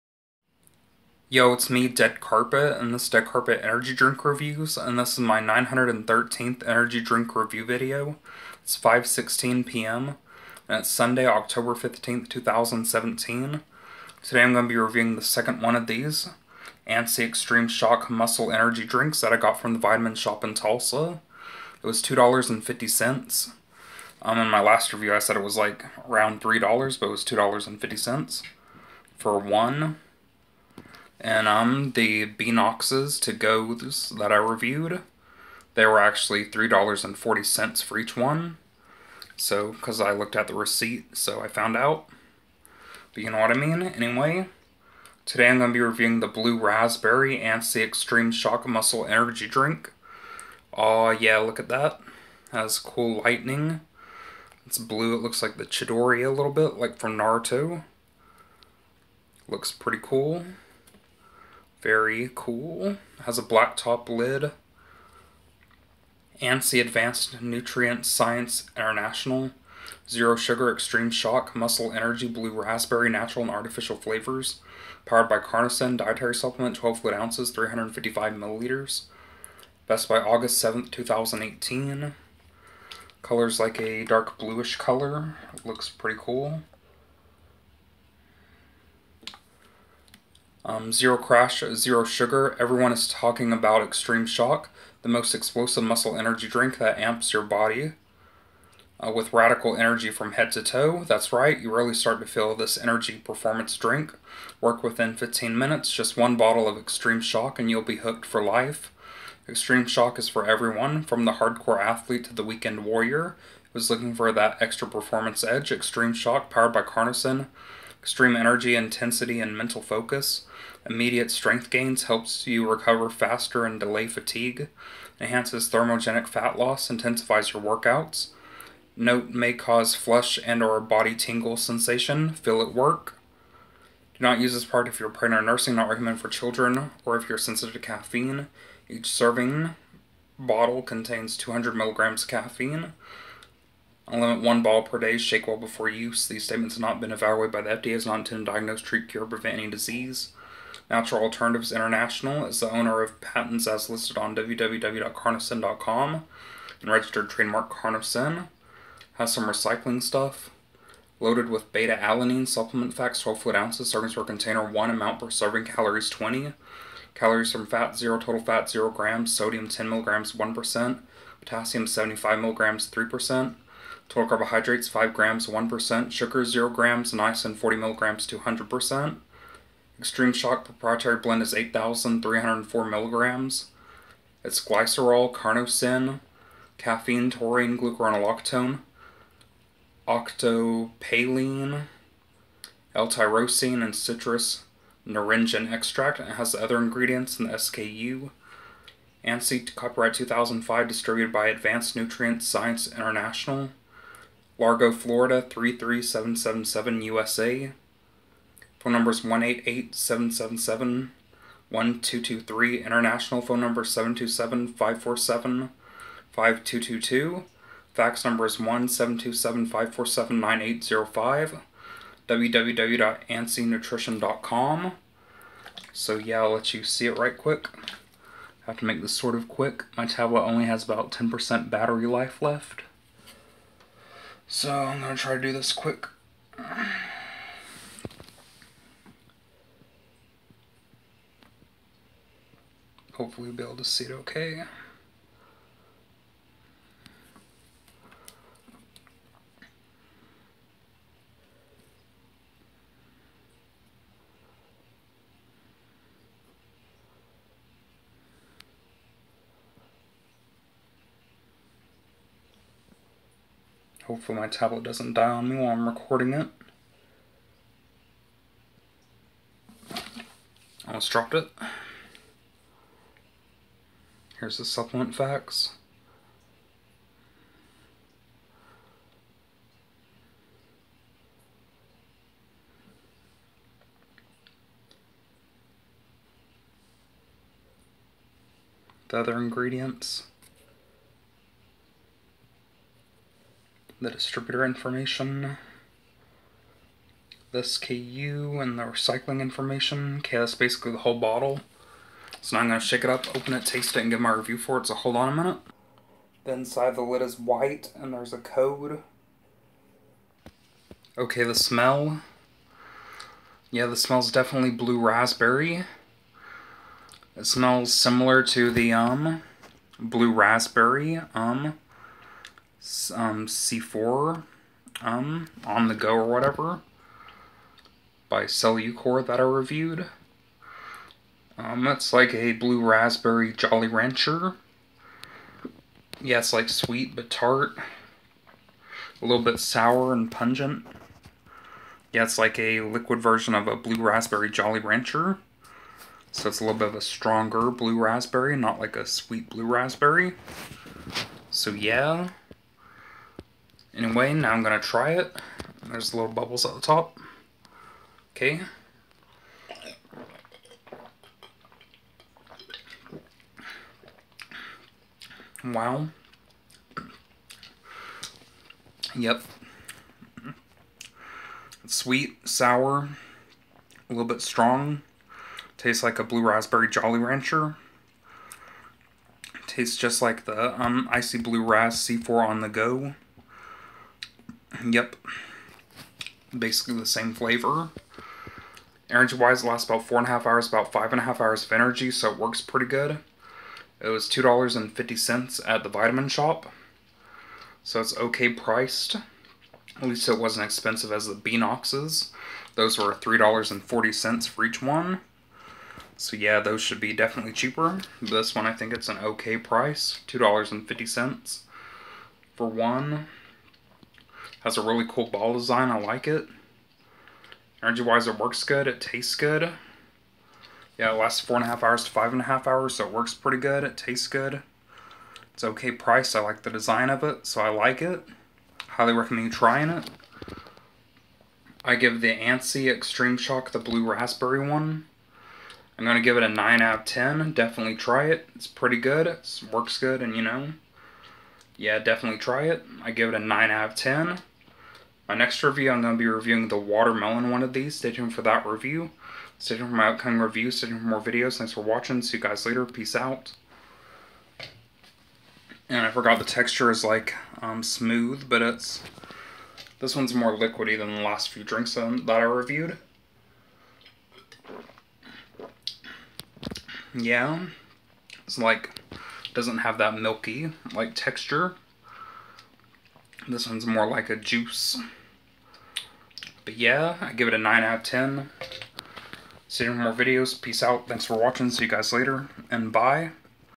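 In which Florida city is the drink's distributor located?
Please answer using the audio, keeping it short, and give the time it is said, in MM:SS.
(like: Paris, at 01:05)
Largo, at 03:24.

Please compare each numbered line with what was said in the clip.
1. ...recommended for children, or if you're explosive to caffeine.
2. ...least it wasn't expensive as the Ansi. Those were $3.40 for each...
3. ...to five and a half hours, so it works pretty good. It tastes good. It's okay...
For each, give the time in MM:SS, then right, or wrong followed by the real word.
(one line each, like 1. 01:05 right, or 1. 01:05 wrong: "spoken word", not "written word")
1. 02:15 wrong: "sensitive", not "explosive"
2. 06:40 wrong: "Beanoxes", not "Ansi"
3. 07:02 right.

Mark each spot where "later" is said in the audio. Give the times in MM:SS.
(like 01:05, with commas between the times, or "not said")
07:32, 08:02.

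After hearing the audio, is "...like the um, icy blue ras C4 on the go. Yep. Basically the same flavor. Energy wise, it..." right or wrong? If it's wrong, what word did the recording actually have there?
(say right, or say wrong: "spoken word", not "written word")
right.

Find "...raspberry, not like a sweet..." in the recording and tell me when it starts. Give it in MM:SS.
05:47.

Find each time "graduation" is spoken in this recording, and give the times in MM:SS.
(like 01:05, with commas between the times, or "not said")
not said.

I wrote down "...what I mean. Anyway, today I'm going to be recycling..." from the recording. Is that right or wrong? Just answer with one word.
wrong.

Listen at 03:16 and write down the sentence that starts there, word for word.
And it has the other ingredients in the SKU.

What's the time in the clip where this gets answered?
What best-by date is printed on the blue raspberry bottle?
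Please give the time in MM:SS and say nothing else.
01:20.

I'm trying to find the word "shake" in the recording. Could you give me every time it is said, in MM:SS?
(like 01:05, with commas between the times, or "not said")
02:25, 05:02.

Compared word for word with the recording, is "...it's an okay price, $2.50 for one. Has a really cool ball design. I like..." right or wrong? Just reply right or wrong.
right.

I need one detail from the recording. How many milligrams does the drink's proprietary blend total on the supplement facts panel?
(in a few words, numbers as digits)
8,304 milligrams.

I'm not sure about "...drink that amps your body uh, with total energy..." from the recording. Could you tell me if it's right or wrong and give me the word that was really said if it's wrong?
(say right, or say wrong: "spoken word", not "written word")
wrong: "radical", not "total".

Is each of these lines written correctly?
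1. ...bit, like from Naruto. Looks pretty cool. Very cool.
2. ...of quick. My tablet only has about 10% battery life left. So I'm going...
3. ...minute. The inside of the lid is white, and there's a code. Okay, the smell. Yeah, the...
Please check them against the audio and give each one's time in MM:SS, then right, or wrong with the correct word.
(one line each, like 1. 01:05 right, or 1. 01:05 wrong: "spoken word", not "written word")
1. 00:56 right
2. 03:49 right
3. 05:05 right.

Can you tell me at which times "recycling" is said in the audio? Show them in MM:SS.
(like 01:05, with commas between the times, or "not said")
02:39, 04:58.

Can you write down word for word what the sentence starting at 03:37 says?
Fax number is 1 727 547 9805.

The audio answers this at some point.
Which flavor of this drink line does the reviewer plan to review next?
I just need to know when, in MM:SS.
07:26.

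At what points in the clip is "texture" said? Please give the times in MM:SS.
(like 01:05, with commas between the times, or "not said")
07:36, 07:51.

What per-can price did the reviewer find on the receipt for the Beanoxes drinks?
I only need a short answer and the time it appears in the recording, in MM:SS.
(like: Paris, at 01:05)
$3.40, at 00:36.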